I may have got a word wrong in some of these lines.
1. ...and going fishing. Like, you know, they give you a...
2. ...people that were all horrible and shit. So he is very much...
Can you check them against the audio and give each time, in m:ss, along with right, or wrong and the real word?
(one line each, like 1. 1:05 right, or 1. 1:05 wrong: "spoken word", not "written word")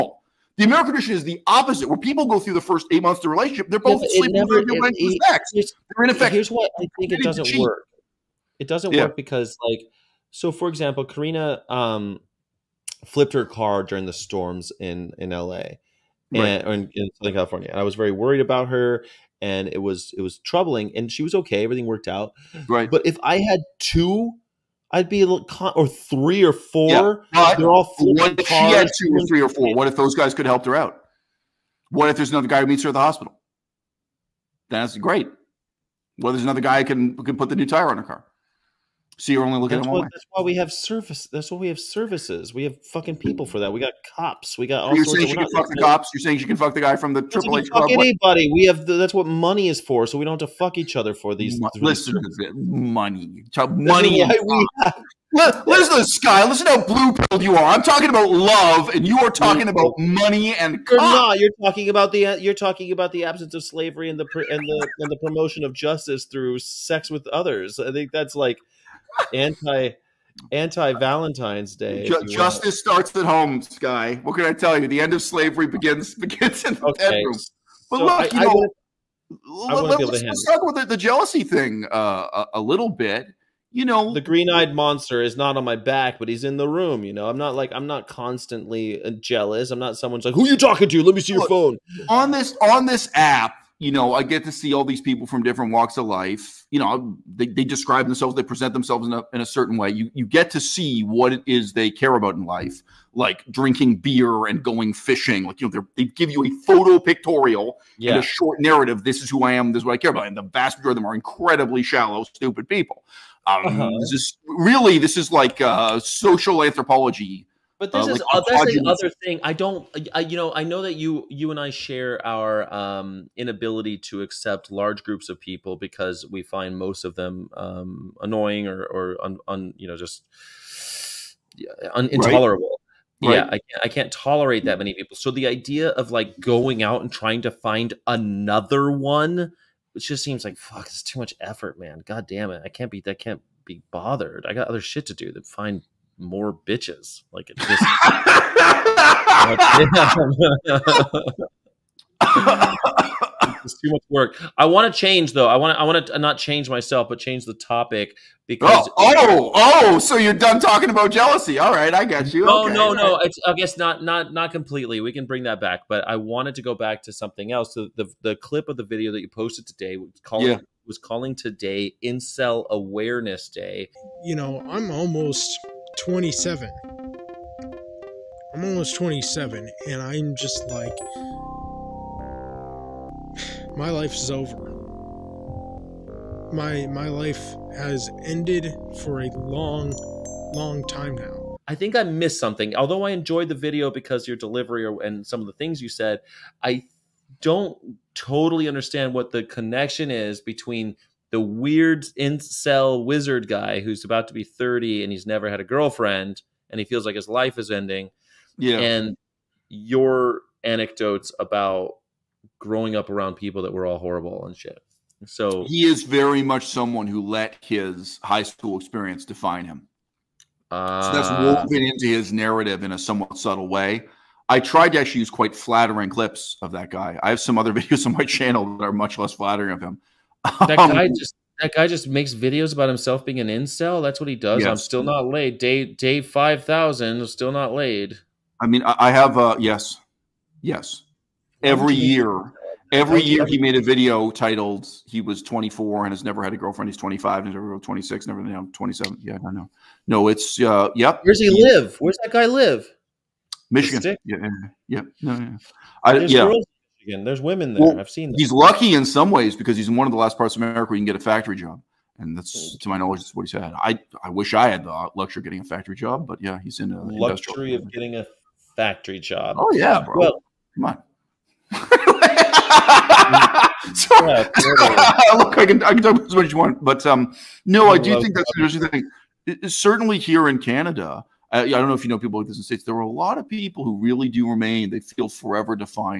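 1. 1:44 right
2. 3:33 right.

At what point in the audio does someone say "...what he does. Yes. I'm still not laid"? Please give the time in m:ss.
3:54.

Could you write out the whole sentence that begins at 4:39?
It, certainly here in Canada, I, uh, I don't know if you know people like this in the States.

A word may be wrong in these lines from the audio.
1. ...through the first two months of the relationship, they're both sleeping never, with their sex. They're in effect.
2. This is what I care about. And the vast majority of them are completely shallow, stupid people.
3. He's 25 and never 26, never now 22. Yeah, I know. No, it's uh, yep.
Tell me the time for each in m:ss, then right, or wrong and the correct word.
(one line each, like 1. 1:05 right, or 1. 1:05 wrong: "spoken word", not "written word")
1. 0:02 wrong: "eight", not "two"
2. 1:49 wrong: "incredibly", not "completely"
3. 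4:06 wrong: "27", not "22".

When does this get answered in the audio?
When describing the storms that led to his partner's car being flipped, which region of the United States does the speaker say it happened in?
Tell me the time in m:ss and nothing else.
0:17.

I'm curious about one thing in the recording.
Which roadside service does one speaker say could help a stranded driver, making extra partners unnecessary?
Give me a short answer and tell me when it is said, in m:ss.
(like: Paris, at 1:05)
Triple H, at 0:47.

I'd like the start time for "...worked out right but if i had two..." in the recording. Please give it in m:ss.
0:21.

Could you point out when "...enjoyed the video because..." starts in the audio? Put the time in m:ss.
3:13.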